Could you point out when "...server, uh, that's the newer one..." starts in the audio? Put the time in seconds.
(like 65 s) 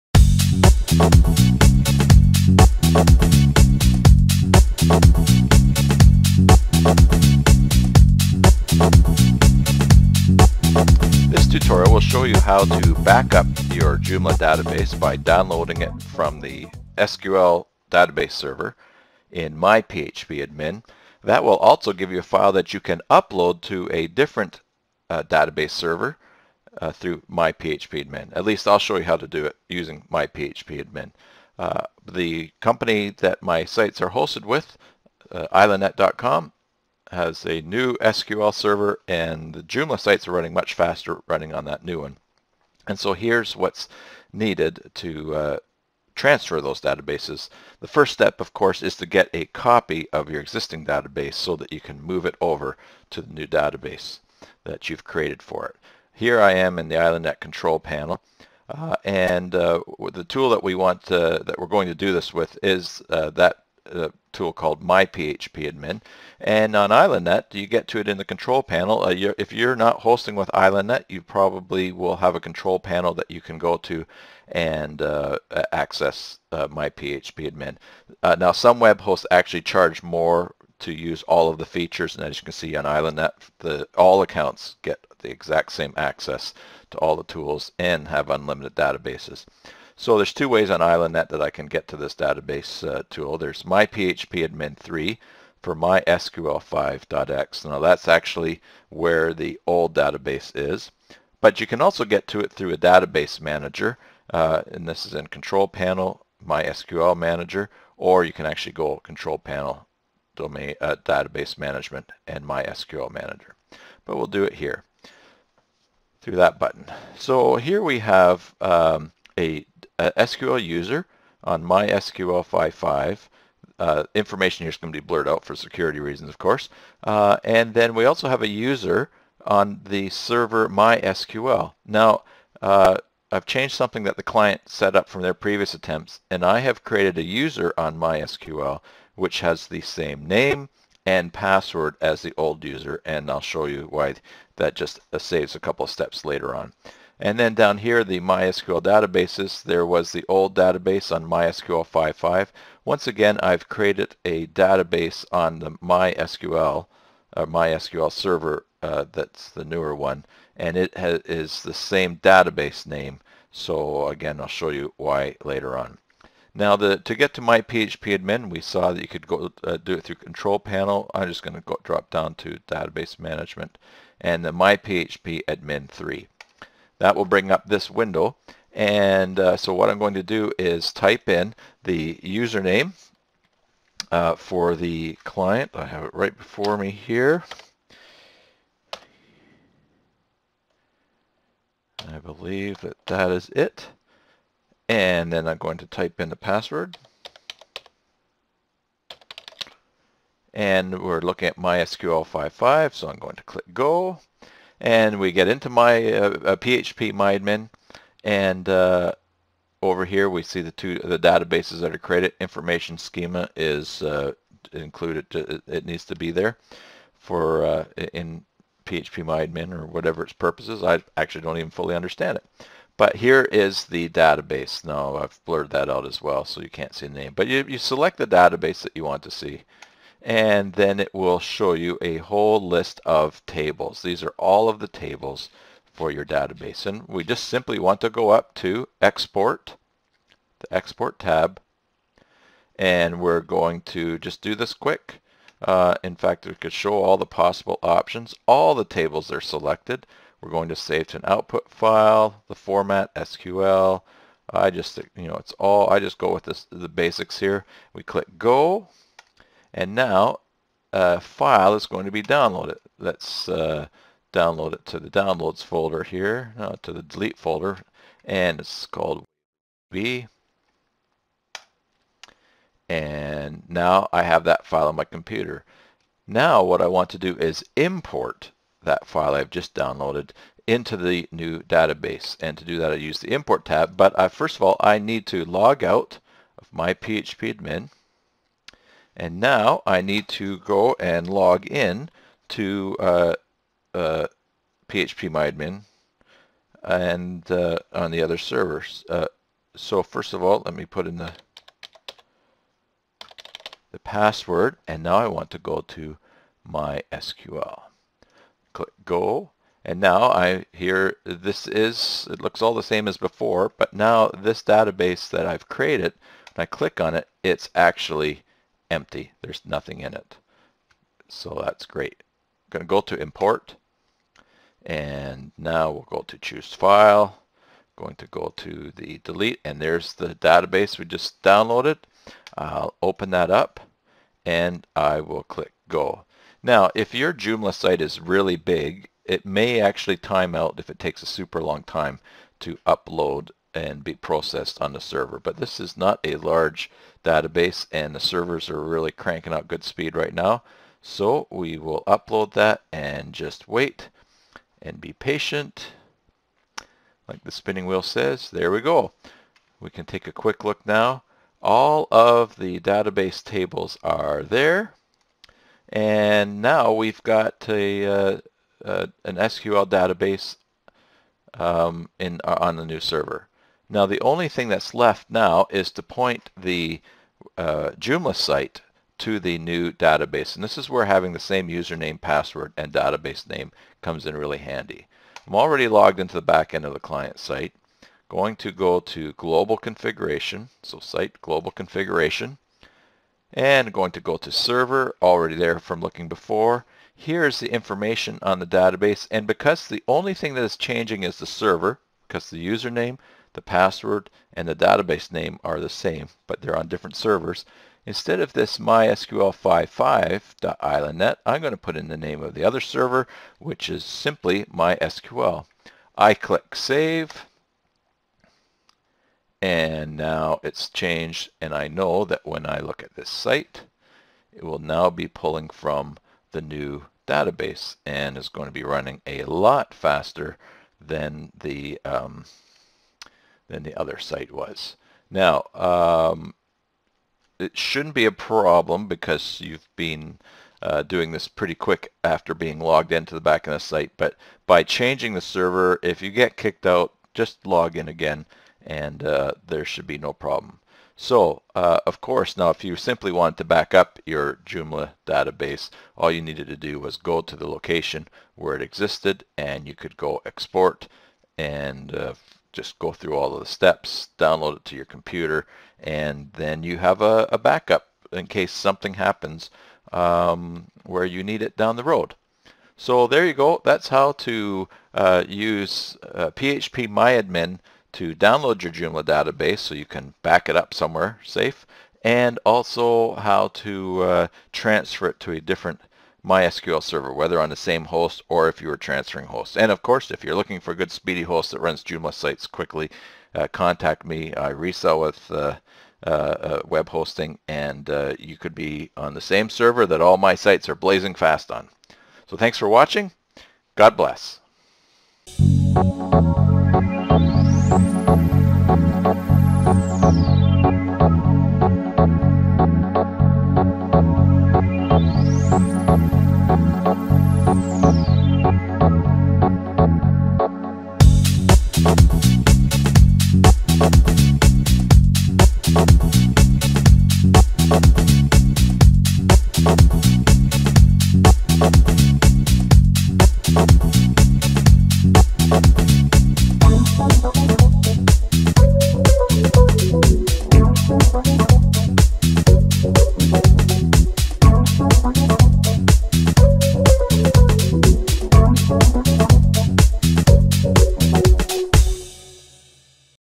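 158 s.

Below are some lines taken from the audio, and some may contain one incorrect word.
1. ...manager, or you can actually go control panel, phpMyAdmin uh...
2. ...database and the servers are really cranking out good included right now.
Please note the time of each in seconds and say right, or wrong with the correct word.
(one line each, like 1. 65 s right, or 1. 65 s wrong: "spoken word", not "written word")
1. 107 s wrong: "domain", not "phpMyAdmin"
2. 347 s wrong: "speed", not "included".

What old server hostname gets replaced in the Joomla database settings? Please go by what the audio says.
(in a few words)
mysql55.islandnet.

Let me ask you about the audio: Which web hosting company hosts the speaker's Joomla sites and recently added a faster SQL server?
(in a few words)
islandnet.com.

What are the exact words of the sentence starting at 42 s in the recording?
And so here's what's needed to uh, transfer those databases.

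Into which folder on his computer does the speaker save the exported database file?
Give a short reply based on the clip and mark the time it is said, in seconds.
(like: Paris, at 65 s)
delete folder, at 267 s.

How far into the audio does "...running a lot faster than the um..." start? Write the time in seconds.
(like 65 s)
428 s.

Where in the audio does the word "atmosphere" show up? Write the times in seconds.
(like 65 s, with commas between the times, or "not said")
not said.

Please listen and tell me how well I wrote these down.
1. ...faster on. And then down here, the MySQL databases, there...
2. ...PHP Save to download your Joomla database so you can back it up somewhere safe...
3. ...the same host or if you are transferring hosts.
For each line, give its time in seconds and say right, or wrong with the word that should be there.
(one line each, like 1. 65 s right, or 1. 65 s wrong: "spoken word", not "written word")
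1. 146 s wrong: "later", not "faster"
2. 476 s wrong: "MyAdmin", not "Save"
3. 487 s right.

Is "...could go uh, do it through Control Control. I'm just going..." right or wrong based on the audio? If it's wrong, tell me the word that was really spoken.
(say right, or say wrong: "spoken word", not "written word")
wrong: "Panel", not "Control".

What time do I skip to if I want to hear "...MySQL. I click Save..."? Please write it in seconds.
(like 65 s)
414 s.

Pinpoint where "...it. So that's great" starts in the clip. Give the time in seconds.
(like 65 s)
320 s.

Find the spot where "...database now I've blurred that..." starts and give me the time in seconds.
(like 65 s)
224 s.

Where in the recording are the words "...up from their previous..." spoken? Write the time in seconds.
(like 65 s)
134 s.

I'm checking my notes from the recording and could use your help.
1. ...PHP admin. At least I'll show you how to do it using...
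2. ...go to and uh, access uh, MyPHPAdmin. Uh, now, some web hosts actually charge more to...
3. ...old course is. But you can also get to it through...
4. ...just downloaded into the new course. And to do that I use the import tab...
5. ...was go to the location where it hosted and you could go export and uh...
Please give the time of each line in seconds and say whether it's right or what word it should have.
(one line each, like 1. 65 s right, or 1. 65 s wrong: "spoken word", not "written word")
1. 27 s right
2. 73 s right
3. 99 s wrong: "database", not "course"
4. 279 s wrong: "database", not "course"
5. 456 s wrong: "existed", not "hosted".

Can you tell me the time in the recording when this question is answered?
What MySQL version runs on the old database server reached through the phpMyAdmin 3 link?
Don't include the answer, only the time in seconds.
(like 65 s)
95 s.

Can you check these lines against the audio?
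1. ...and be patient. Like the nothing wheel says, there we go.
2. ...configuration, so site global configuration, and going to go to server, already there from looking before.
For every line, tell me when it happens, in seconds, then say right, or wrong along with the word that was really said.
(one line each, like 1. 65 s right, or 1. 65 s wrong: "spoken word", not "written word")
1. 354 s wrong: "spinning", not "nothing"
2. 389 s right.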